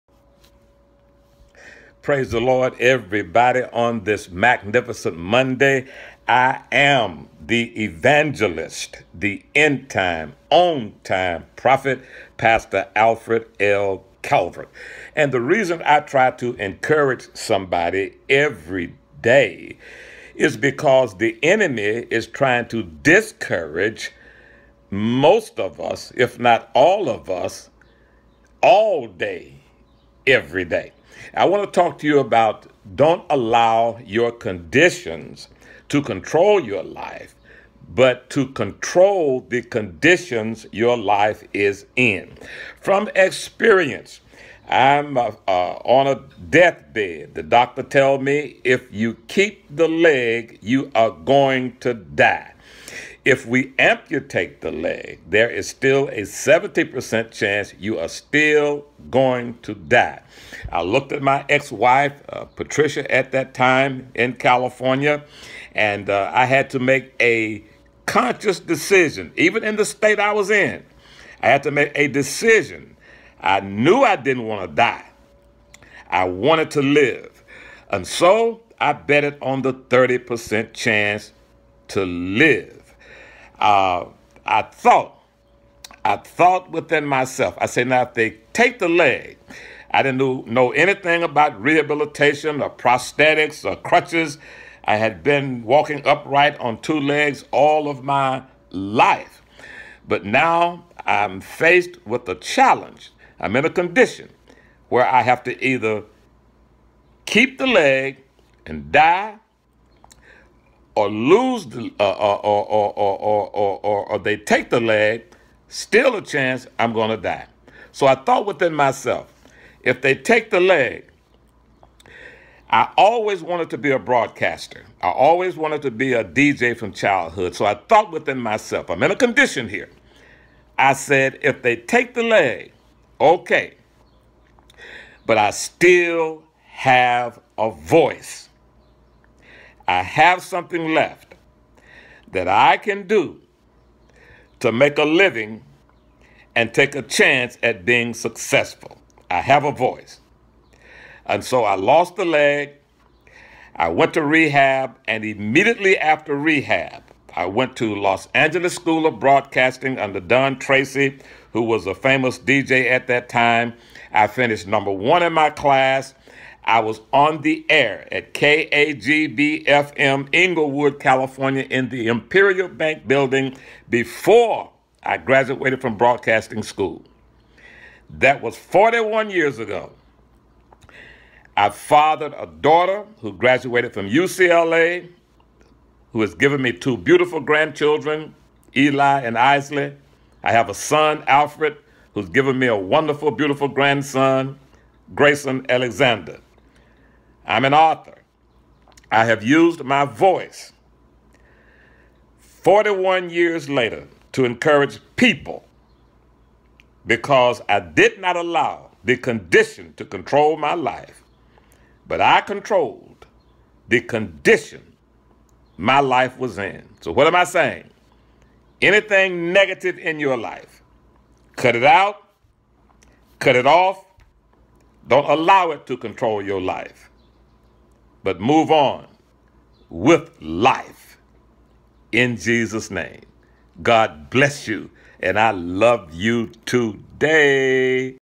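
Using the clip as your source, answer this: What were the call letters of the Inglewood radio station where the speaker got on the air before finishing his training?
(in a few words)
KAGB FM.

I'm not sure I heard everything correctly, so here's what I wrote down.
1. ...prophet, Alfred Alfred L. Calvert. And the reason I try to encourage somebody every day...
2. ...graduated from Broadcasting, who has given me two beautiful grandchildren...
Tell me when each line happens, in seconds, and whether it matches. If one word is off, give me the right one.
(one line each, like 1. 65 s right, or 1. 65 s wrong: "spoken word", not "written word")
1. 11 s wrong: "Pastor", not "Alfred"
2. 183 s wrong: "UCLA", not "Broadcasting".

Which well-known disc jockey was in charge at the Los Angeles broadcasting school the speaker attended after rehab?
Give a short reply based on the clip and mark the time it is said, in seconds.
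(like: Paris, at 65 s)
Don Tracy, at 160 s.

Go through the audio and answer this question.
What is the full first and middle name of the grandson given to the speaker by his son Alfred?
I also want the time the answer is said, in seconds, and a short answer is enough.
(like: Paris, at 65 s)
Grayson Alexander, at 195 s.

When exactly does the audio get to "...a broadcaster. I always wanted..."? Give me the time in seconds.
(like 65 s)
123 s.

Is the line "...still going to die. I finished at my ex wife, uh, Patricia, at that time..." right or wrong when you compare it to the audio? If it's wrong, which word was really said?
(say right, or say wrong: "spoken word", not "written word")
wrong: "looked", not "finished".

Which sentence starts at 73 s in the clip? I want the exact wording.
I knew I didn't want to die, I wanted to live.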